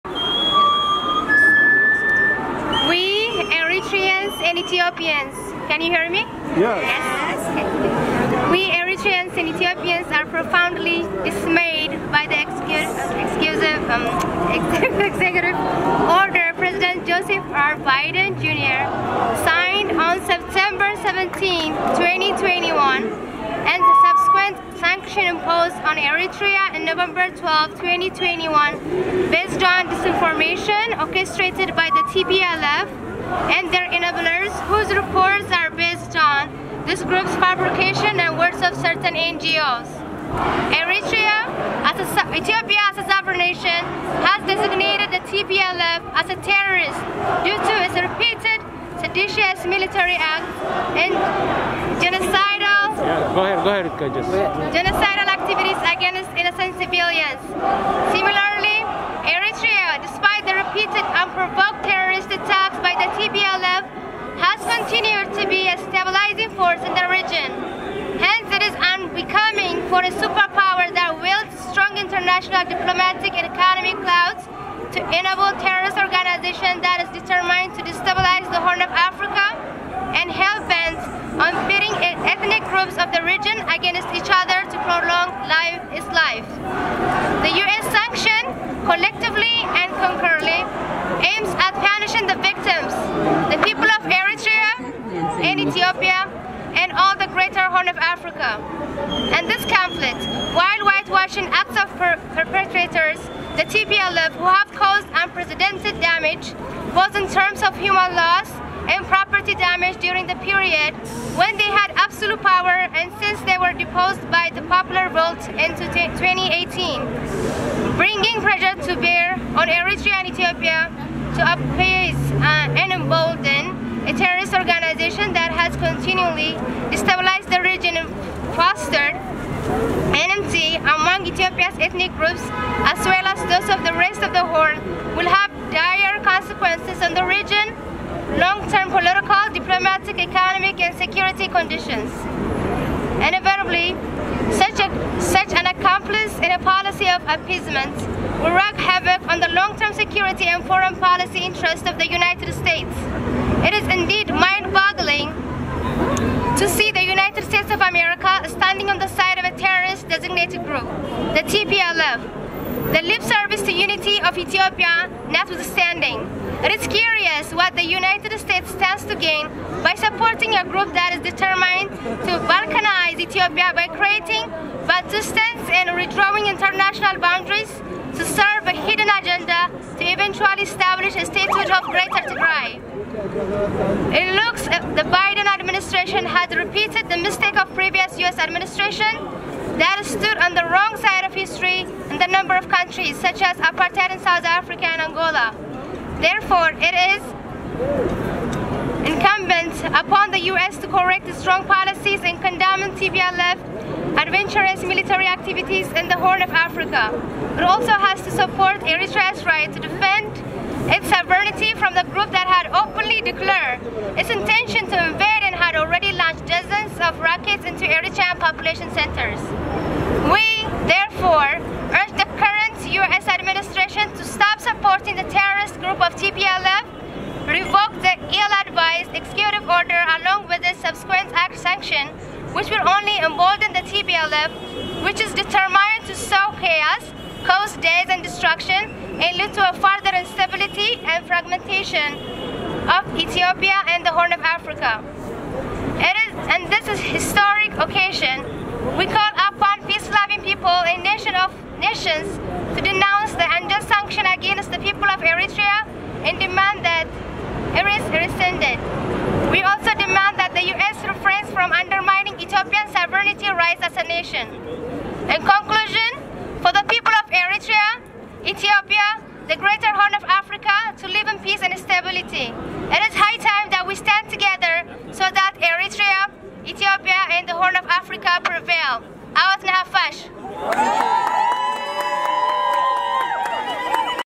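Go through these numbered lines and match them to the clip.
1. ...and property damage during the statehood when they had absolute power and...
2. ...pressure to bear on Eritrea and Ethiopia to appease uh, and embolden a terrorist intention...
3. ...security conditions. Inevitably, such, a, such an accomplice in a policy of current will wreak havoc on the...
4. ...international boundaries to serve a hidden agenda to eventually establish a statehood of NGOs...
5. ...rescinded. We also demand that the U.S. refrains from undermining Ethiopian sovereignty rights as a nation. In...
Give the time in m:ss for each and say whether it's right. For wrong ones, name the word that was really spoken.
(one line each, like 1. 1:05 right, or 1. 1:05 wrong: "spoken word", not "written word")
1. 1:48 wrong: "period", not "statehood"
2. 1:58 wrong: "organization", not "intention"
3. 2:21 wrong: "appeasement", not "current"
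4. 2:56 wrong: "Greater", not "NGOs"
5. 4:18 right.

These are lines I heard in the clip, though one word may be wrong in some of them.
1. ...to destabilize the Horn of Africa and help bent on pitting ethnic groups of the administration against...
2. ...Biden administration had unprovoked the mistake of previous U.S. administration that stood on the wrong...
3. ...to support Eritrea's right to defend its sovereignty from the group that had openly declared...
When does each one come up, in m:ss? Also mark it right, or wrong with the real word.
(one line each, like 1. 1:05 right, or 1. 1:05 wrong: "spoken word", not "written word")
1. 1:17 wrong: "region", not "administration"
2. 3:05 wrong: "repeated", not "unprovoked"
3. 3:28 right.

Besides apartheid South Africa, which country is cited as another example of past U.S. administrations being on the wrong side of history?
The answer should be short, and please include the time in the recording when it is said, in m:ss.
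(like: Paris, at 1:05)
Angola, at 3:15.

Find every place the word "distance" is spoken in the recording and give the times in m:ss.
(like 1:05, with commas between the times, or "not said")
2:55.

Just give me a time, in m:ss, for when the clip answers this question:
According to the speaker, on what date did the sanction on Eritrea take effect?
0:26.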